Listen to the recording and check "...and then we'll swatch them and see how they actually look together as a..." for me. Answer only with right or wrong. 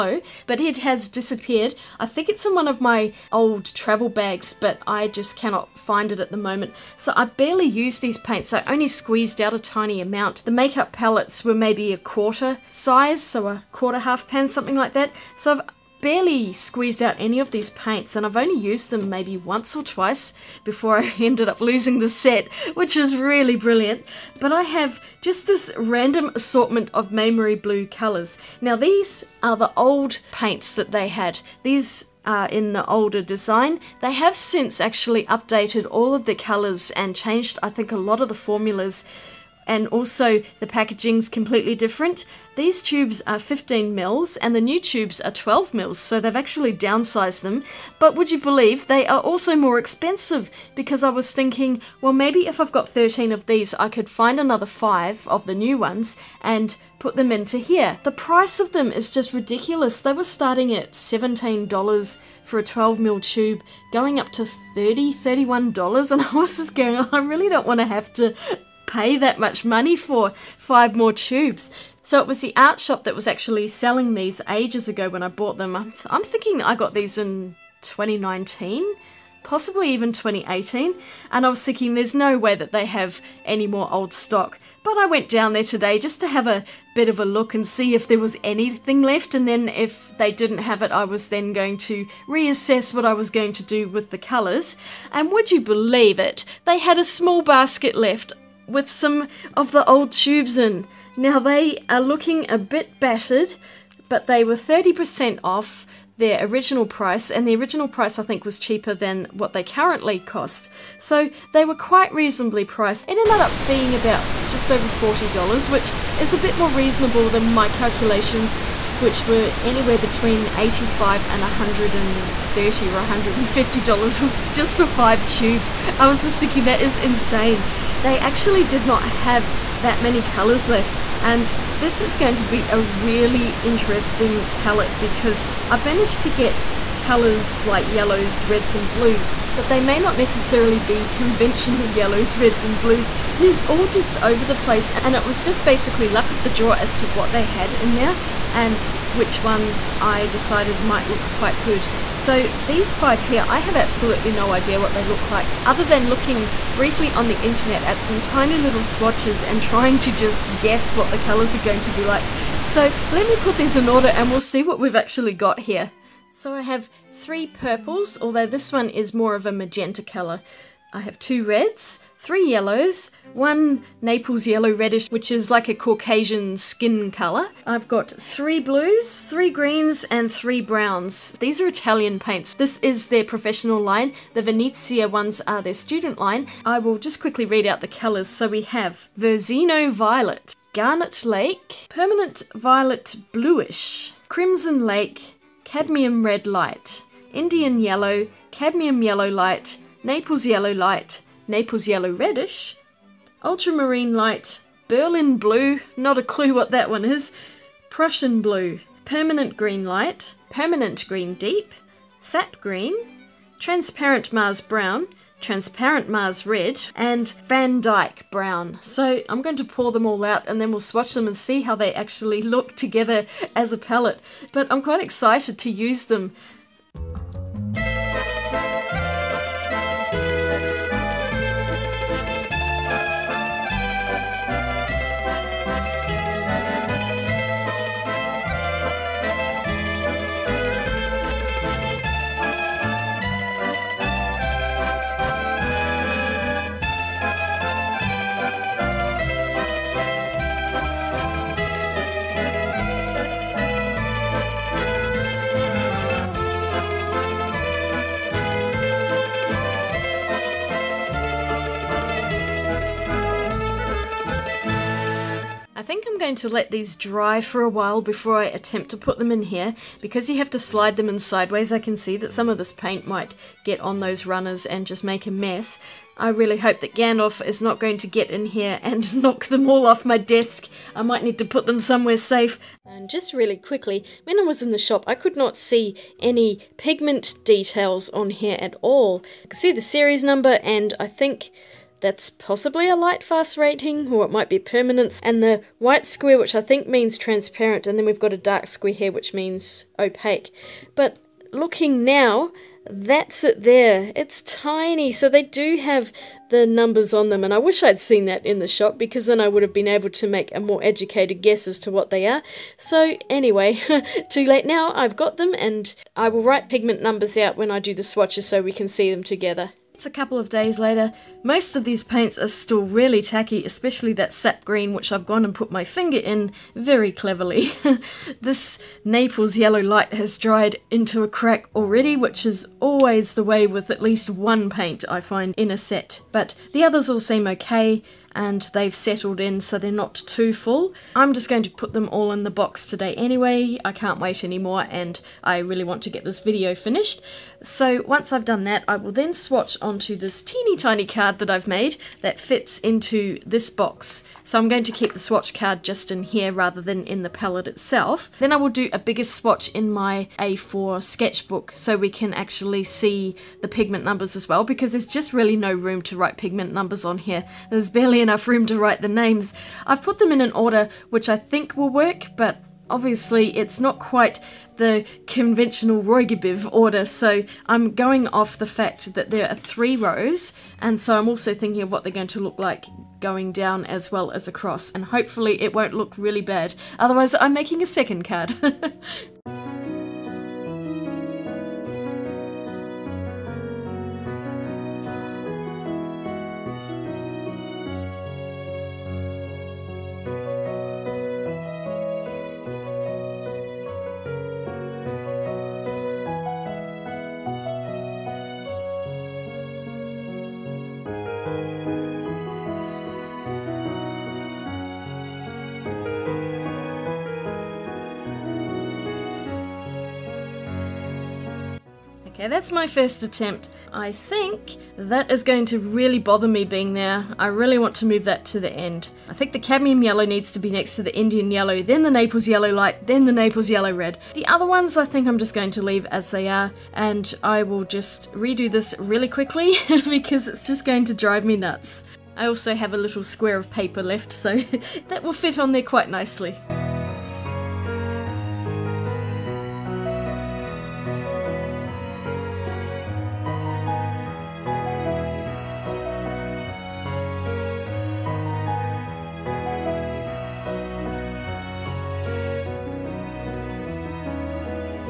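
right.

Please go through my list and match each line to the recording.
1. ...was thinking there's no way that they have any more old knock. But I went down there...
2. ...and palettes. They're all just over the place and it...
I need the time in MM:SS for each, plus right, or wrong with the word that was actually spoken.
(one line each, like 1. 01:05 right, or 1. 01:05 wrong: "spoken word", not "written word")
1. 01:21 wrong: "stock", not "knock"
2. 02:22 wrong: "blues", not "palettes".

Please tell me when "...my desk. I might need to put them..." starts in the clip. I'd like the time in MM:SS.
04:40.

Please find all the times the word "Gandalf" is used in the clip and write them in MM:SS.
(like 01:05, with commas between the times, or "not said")
04:36.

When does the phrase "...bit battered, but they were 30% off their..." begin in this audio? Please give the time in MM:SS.
01:42.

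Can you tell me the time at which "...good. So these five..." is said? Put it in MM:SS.
02:31.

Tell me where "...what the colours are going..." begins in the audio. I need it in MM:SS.
02:40.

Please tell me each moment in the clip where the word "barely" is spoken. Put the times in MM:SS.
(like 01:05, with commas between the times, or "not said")
00:07, 00:16, 06:07.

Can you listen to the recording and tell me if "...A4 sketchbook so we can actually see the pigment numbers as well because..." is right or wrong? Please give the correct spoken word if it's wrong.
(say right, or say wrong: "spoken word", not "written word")
right.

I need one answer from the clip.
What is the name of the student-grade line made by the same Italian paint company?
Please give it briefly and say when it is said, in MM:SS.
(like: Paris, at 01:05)
Venezia, at 03:04.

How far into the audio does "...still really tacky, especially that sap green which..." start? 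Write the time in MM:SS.
05:22.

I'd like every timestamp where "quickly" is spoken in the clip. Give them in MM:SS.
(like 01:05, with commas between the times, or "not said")
03:07, 04:43, 07:19.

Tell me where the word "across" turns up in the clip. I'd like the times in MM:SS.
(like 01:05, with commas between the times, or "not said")
06:24.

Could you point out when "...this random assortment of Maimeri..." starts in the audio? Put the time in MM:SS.
00:25.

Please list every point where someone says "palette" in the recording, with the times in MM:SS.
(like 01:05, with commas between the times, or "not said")
00:10, 02:14, 03:43, 05:57.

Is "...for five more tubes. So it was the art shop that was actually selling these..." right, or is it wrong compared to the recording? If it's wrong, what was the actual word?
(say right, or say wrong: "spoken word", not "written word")
right.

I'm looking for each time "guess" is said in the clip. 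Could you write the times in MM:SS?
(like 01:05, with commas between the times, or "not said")
02:40, 05:11.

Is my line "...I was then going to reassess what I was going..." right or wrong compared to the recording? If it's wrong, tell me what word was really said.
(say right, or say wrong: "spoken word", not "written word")
right.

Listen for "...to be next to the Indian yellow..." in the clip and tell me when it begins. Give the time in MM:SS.
07:10.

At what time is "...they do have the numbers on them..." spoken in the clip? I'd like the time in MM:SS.
05:05.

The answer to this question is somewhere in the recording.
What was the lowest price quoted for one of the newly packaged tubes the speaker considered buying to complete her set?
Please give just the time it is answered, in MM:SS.
01:00.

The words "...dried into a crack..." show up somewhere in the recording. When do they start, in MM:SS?
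05:30.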